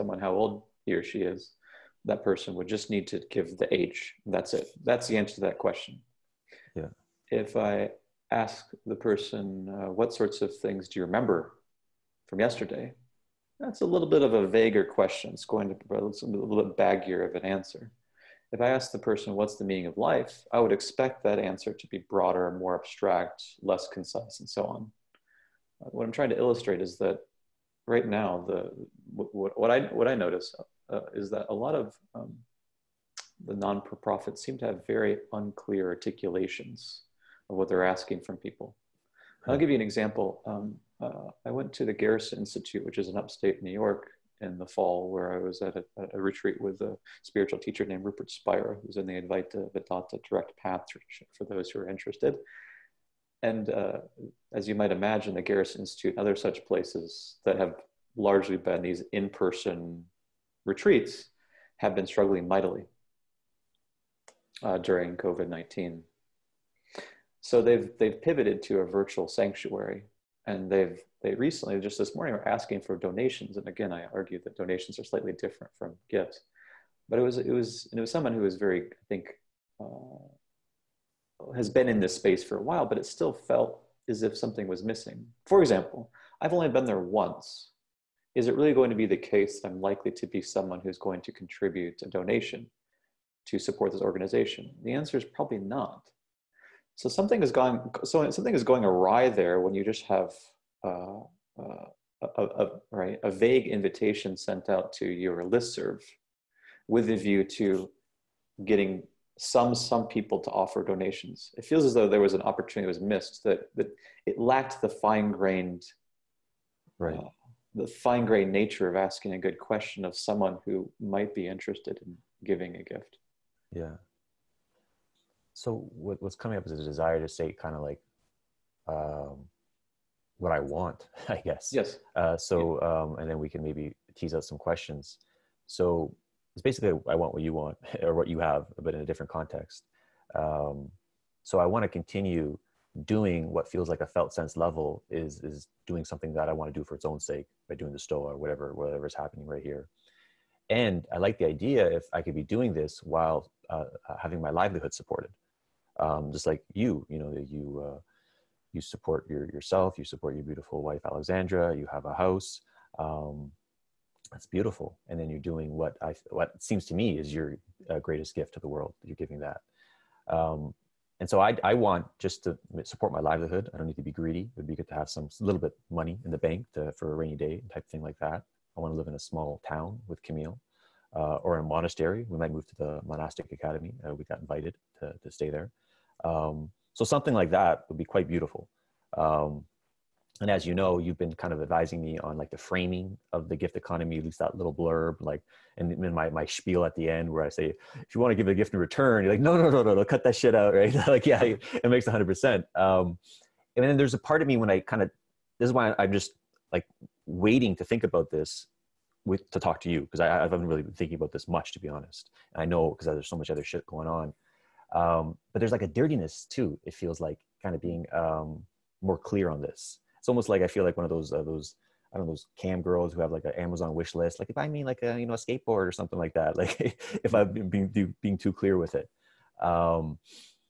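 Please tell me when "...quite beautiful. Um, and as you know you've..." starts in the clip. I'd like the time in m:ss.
3:08.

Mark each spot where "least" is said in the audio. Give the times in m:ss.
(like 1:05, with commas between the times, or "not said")
3:14.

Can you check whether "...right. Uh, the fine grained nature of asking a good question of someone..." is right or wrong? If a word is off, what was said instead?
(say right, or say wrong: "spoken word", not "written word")
right.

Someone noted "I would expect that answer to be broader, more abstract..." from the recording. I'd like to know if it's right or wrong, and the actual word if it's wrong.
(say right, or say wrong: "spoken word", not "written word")
right.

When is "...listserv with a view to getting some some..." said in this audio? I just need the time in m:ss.
1:45.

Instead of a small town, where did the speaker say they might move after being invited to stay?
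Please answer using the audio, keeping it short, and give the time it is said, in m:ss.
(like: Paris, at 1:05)
The Monastic Academy, at 3:03.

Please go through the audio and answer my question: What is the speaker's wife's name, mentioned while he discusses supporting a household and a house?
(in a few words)
Alexandra.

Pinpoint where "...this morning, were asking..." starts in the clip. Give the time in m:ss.
1:11.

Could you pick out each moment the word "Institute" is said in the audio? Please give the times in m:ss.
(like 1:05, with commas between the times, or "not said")
0:42, 0:55.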